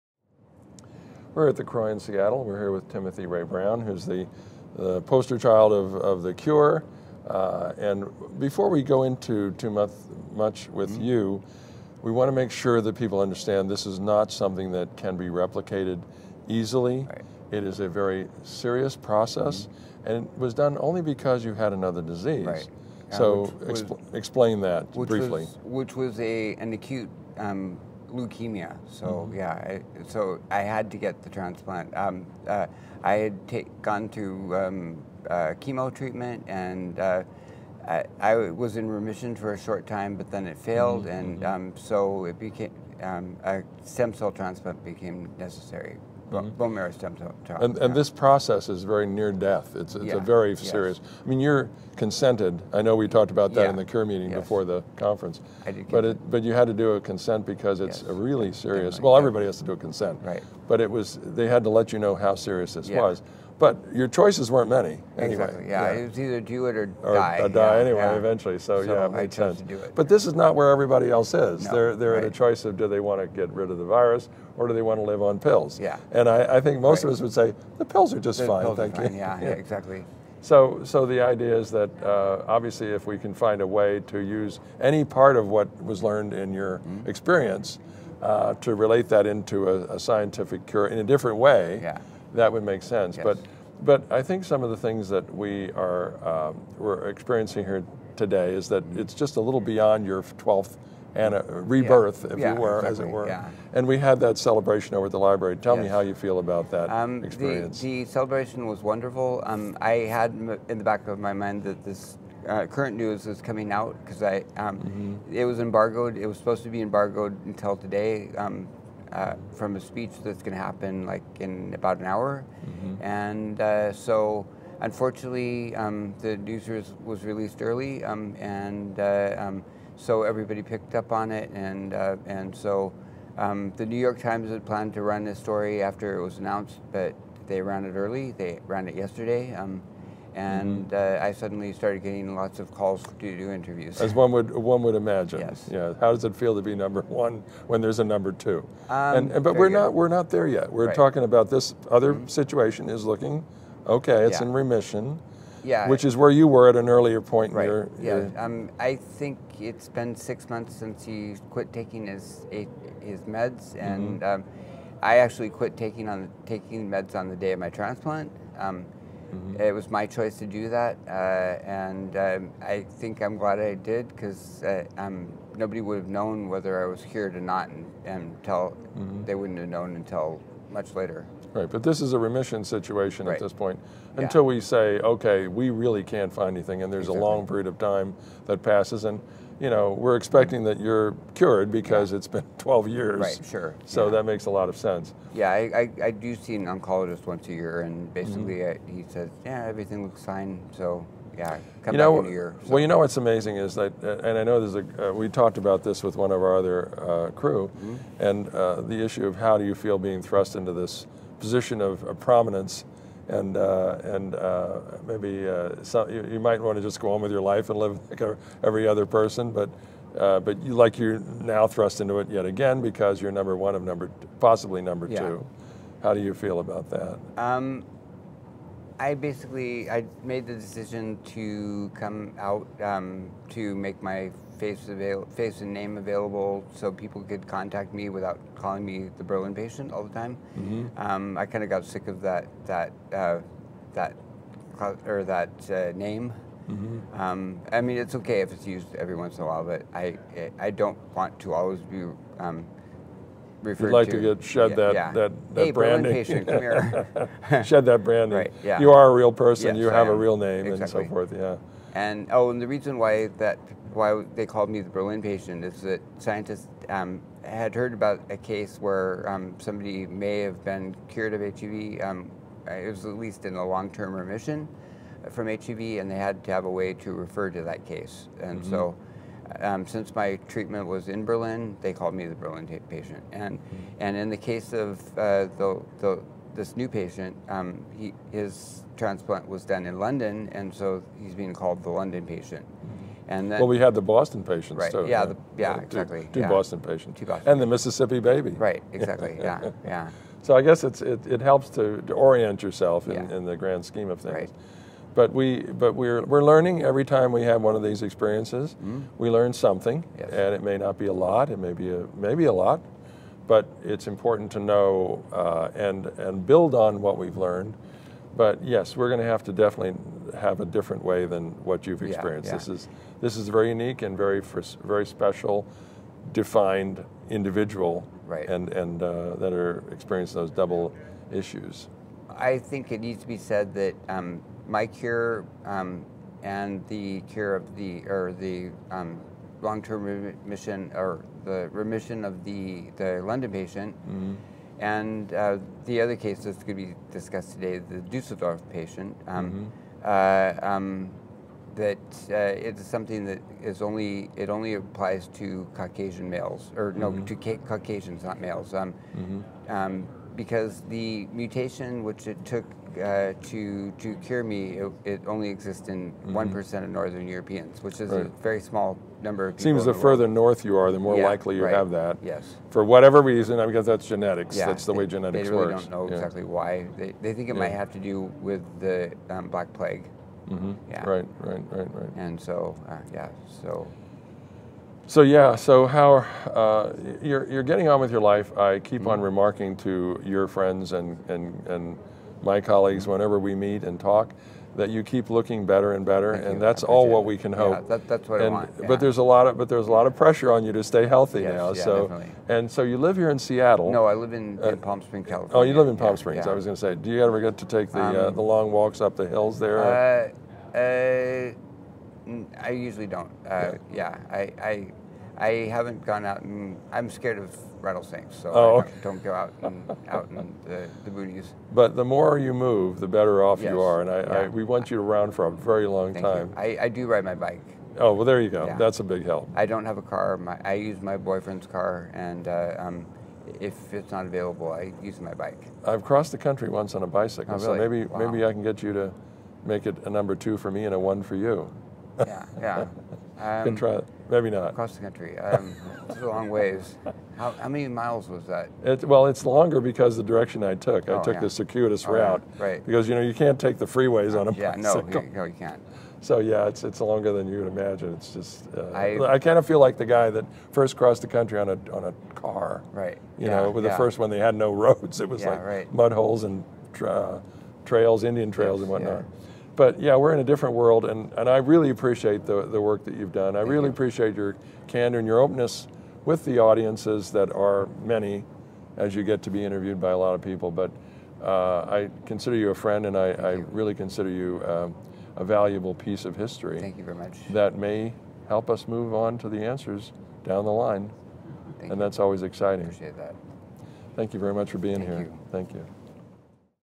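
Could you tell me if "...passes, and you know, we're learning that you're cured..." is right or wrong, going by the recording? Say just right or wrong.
wrong.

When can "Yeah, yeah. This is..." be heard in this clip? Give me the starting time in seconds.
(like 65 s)
322 s.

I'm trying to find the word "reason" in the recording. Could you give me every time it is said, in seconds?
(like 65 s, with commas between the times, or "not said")
262 s, 373 s.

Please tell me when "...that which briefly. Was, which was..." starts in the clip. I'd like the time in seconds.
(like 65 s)
24 s.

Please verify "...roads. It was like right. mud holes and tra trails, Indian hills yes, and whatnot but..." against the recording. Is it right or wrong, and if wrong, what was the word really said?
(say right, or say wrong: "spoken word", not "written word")
wrong: "trails", not "hills".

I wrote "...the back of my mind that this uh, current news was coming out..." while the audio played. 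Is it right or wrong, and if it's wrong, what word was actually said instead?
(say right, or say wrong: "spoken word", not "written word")
right.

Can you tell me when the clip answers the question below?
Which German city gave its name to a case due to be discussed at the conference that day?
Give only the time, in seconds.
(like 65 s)
347 s.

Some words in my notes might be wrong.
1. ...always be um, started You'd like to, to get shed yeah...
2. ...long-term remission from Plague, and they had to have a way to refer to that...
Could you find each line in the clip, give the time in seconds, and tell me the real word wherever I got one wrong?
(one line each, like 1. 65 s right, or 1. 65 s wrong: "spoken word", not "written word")
1. 251 s wrong: "referred", not "started"
2. 273 s wrong: "HIV", not "Plague".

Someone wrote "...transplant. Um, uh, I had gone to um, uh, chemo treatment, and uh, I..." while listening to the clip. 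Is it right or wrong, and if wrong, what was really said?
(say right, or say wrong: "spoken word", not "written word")
right.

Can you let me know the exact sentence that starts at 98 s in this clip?
it's just a little beyond your 12th and uh, rebirth, yeah.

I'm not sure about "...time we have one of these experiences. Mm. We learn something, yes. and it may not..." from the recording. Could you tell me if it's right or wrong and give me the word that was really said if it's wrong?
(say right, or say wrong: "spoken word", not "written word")
right.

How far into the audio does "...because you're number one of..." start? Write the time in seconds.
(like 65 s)
222 s.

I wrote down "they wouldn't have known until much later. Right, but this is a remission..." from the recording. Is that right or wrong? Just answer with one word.
right.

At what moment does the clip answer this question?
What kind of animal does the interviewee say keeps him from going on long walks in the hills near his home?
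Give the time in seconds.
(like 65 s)
417 s.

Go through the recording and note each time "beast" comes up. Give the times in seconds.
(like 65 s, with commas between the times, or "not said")
not said.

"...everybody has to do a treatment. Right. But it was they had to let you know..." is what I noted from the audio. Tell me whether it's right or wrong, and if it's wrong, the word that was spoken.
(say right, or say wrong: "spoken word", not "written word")
wrong: "consent", not "treatment".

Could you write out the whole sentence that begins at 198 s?
I, uh, he says, yeah, everything looks fine.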